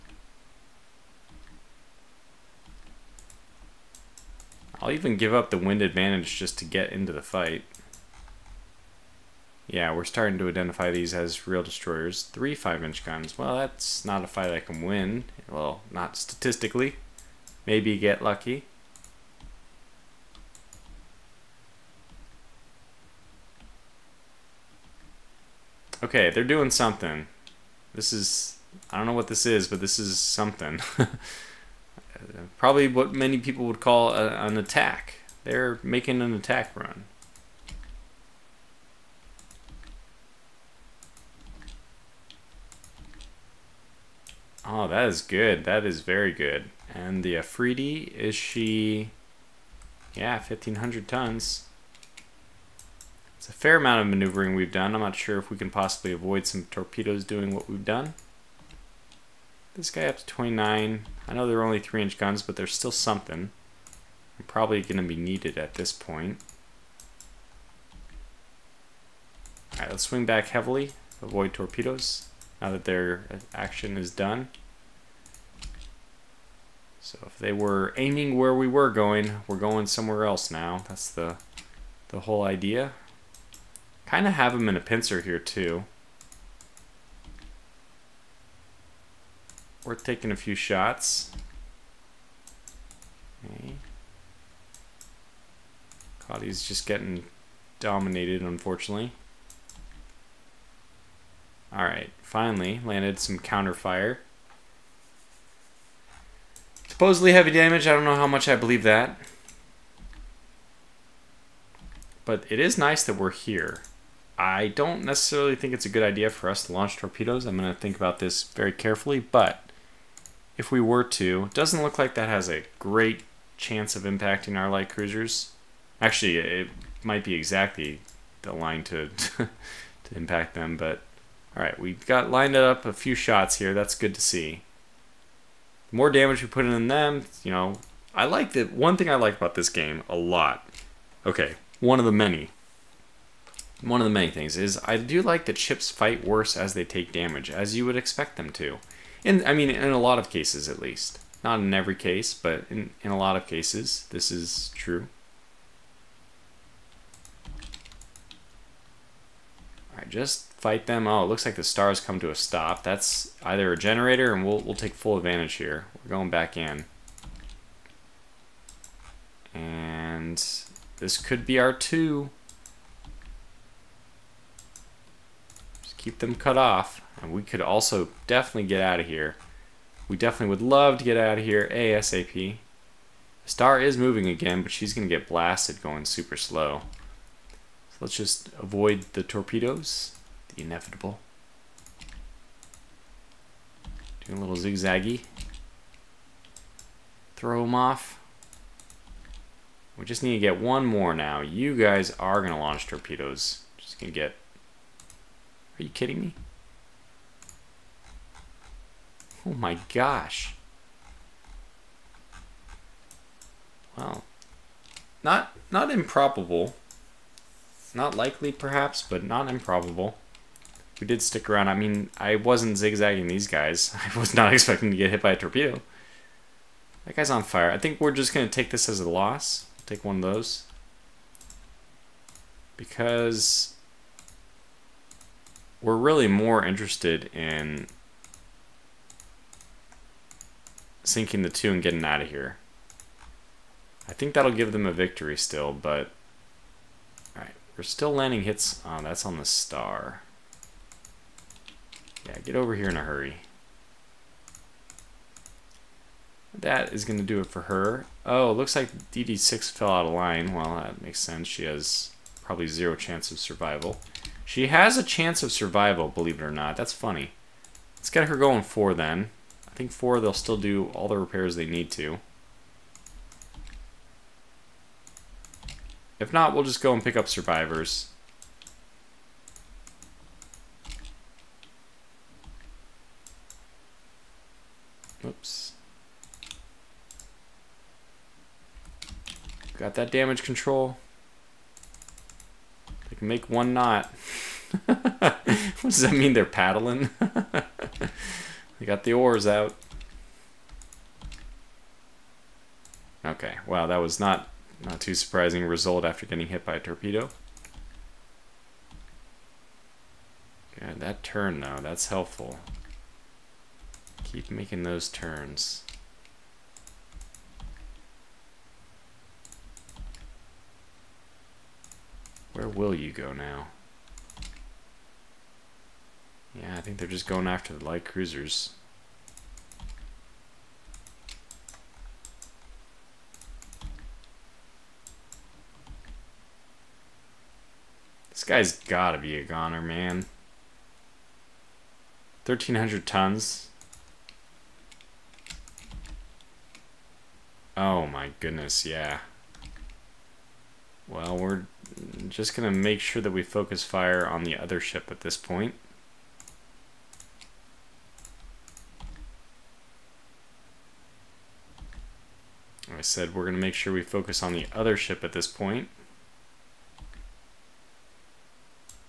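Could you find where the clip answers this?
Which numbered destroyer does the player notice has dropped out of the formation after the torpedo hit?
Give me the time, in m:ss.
4:19.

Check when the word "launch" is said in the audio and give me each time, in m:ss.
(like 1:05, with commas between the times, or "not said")
1:56, 3:22.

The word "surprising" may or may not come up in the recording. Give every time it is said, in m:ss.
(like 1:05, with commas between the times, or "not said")
5:05.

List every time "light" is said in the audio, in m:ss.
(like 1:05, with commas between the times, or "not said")
2:04, 5:27.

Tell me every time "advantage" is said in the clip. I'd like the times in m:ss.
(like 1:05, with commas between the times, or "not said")
0:05, 2:45.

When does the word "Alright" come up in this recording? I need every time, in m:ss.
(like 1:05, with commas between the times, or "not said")
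1:09, 4:07.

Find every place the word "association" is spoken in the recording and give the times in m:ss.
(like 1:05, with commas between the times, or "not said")
not said.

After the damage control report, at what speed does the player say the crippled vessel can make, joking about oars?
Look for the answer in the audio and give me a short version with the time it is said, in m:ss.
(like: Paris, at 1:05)
1 knot, at 4:53.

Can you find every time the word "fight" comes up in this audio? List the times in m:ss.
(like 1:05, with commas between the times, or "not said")
0:07, 0:14, 2:25, 2:40.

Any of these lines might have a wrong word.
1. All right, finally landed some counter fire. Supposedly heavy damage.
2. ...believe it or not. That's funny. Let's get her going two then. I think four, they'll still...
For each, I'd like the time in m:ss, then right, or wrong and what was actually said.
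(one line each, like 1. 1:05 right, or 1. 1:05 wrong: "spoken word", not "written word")
1. 1:41 right
2. 4:26 wrong: "four", not "two".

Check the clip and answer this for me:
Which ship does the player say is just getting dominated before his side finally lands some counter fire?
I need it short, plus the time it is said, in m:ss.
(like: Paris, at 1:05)
Caudy, at 1:36.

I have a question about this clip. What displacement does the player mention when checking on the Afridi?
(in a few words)
1,500 tons.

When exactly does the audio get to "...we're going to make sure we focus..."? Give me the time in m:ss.
6:03.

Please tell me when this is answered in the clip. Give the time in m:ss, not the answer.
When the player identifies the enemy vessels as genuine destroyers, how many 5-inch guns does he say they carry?
0:12.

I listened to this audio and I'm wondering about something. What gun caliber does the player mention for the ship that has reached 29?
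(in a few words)
3-inch.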